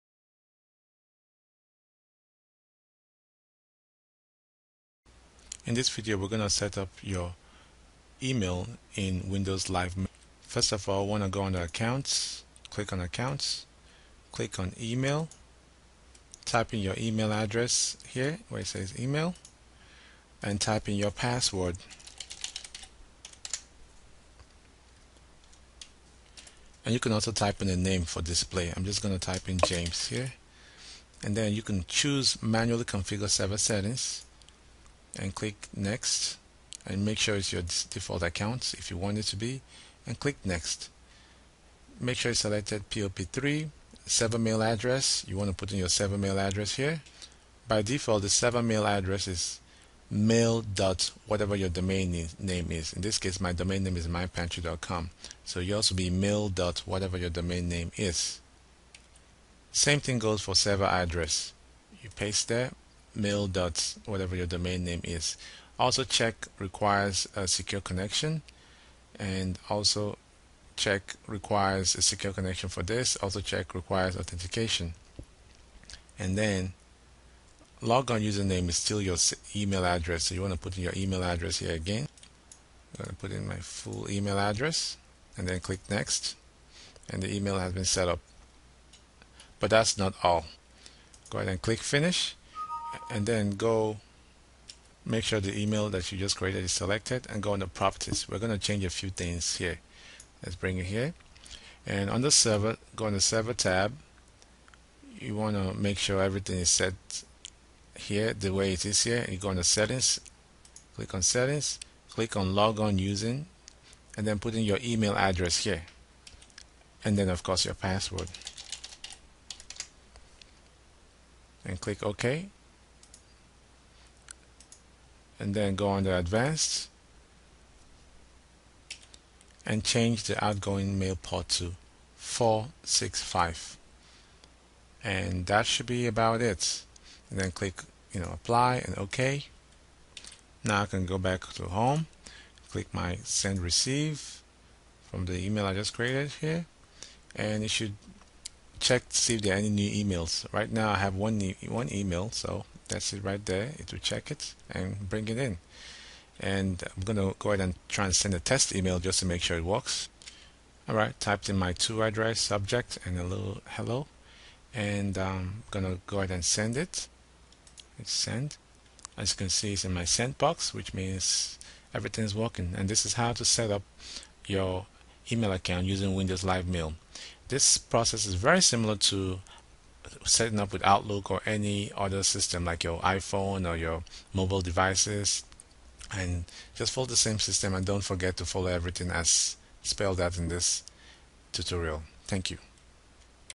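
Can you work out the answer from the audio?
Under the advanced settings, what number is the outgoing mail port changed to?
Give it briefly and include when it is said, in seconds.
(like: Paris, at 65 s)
465, at 132 s.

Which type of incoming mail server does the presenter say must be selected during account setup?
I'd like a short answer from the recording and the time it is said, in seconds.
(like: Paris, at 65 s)
POP3, at 42 s.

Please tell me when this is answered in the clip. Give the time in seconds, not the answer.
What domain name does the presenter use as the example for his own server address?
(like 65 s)
54 s.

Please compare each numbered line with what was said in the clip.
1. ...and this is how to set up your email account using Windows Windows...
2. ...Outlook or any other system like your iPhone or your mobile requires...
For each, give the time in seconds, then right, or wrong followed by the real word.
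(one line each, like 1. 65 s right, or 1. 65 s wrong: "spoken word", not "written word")
1. 172 s wrong: "Live", not "Windows"
2. 180 s wrong: "devices", not "requires".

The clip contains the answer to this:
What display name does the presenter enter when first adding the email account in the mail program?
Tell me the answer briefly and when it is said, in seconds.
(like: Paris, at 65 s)
James, at 29 s.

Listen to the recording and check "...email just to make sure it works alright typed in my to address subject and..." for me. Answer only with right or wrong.
right.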